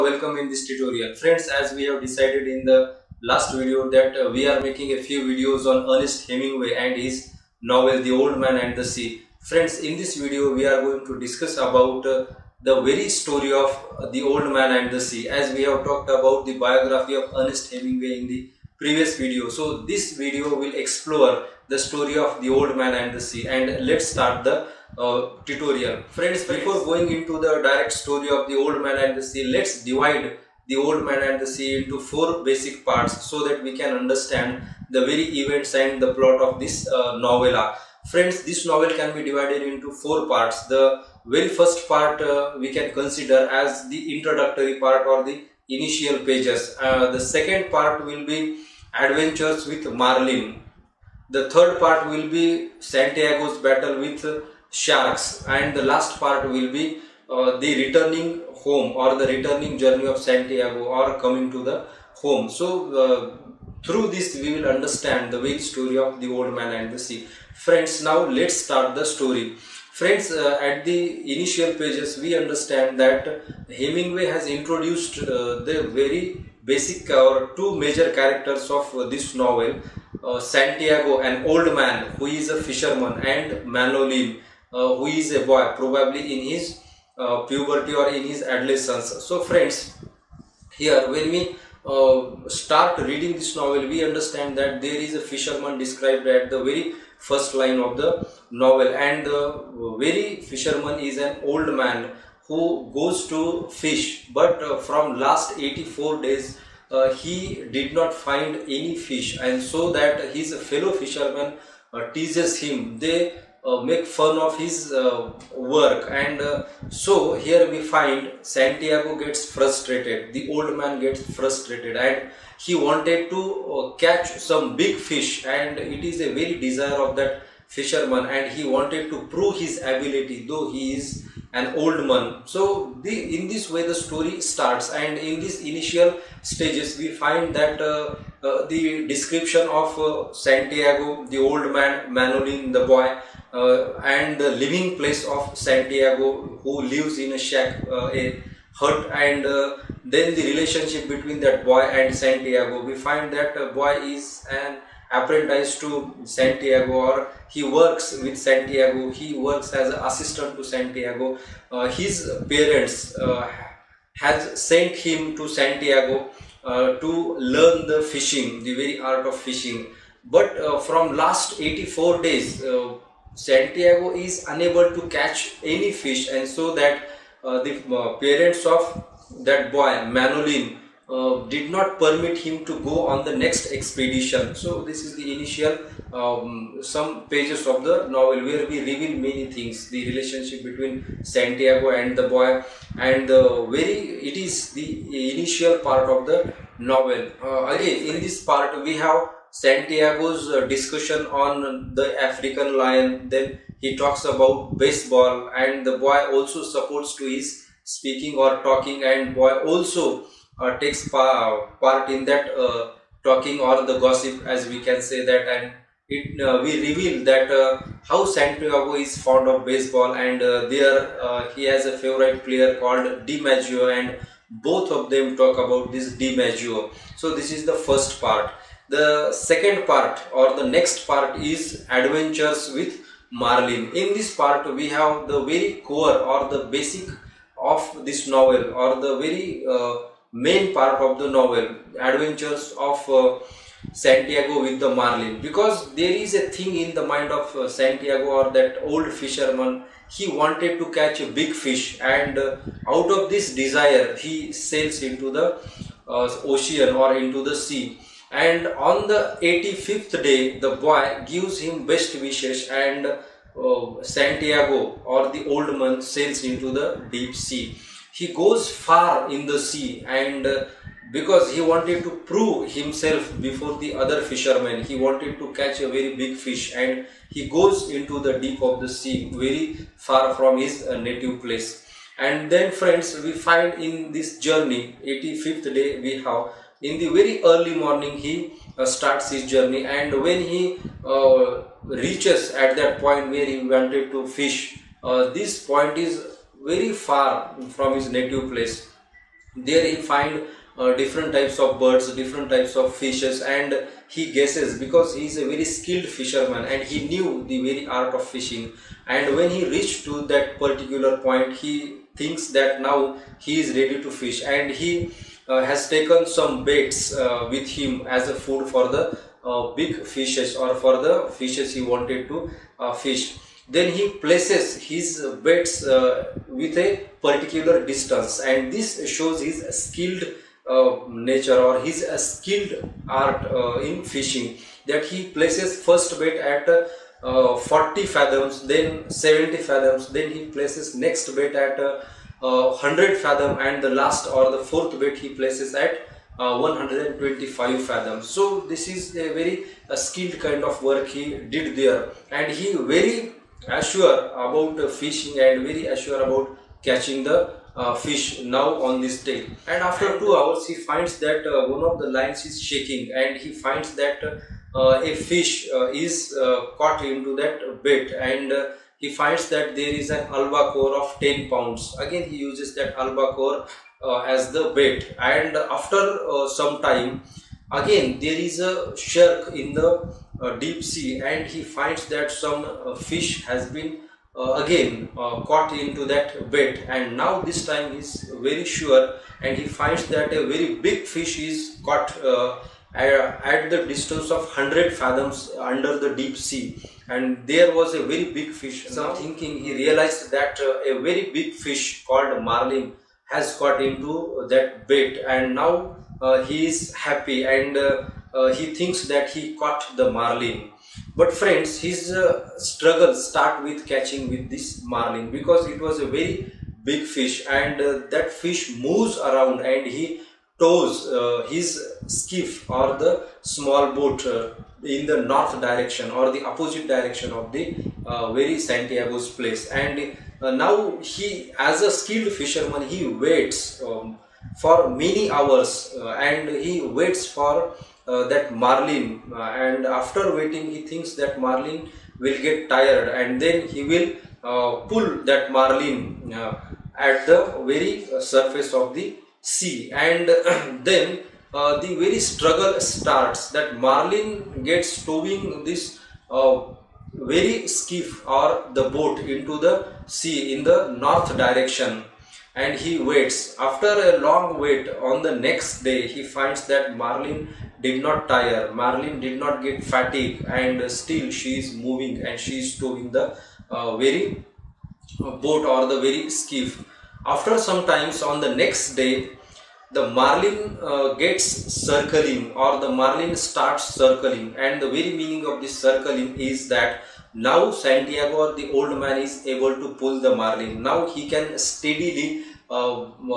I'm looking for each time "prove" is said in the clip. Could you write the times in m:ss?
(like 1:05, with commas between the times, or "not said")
2:09, 4:32.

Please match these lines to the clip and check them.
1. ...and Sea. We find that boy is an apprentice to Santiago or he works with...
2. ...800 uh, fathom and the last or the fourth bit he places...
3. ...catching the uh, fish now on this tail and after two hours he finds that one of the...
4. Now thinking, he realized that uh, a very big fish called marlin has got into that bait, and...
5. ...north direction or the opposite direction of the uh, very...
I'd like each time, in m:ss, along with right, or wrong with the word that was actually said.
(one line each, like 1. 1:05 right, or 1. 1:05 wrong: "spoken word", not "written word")
1. 2:31 wrong: "Santiago", not "Sea"
2. 5:42 wrong: "100", not "800"
3. 5:56 right
4. 6:38 right
5. 7:05 right.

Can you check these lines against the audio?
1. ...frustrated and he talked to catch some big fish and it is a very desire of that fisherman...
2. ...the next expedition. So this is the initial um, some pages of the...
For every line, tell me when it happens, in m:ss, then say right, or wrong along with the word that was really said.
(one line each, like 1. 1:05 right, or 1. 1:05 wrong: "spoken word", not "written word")
1. 2:01 wrong: "wanted", not "talked"
2. 3:03 right.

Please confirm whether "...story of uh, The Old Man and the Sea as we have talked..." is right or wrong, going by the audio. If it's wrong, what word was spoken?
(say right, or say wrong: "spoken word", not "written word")
right.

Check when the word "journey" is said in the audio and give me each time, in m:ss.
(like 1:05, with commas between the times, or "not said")
0:59, 4:44, 4:49.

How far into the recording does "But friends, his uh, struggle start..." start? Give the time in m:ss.
6:51.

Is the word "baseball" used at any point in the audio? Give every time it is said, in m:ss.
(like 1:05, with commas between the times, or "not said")
3:24, 3:39.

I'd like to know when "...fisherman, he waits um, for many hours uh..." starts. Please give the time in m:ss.
7:12.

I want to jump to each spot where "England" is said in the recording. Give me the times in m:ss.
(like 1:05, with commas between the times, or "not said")
not said.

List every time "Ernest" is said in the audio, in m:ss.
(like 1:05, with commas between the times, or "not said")
0:05, 0:17.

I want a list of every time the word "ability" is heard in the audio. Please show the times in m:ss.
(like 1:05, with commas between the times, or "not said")
2:09.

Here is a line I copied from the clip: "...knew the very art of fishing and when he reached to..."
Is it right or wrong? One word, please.
right.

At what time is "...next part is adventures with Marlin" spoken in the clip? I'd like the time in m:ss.
3:50.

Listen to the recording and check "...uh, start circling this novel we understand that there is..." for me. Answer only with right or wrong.
wrong.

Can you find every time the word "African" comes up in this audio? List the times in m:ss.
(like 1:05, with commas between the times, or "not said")
3:22.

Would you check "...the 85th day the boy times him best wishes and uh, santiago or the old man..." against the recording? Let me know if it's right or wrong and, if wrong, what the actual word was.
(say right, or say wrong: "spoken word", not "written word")
wrong: "gives", not "times".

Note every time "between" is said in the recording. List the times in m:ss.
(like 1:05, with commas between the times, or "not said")
2:31, 3:10.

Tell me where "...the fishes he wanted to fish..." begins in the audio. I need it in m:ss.
5:21.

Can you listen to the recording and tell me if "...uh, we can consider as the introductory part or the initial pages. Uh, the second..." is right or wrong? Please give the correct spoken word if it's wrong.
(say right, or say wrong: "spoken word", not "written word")
right.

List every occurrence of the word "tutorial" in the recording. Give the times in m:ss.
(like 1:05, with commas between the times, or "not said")
0:00, 0:25.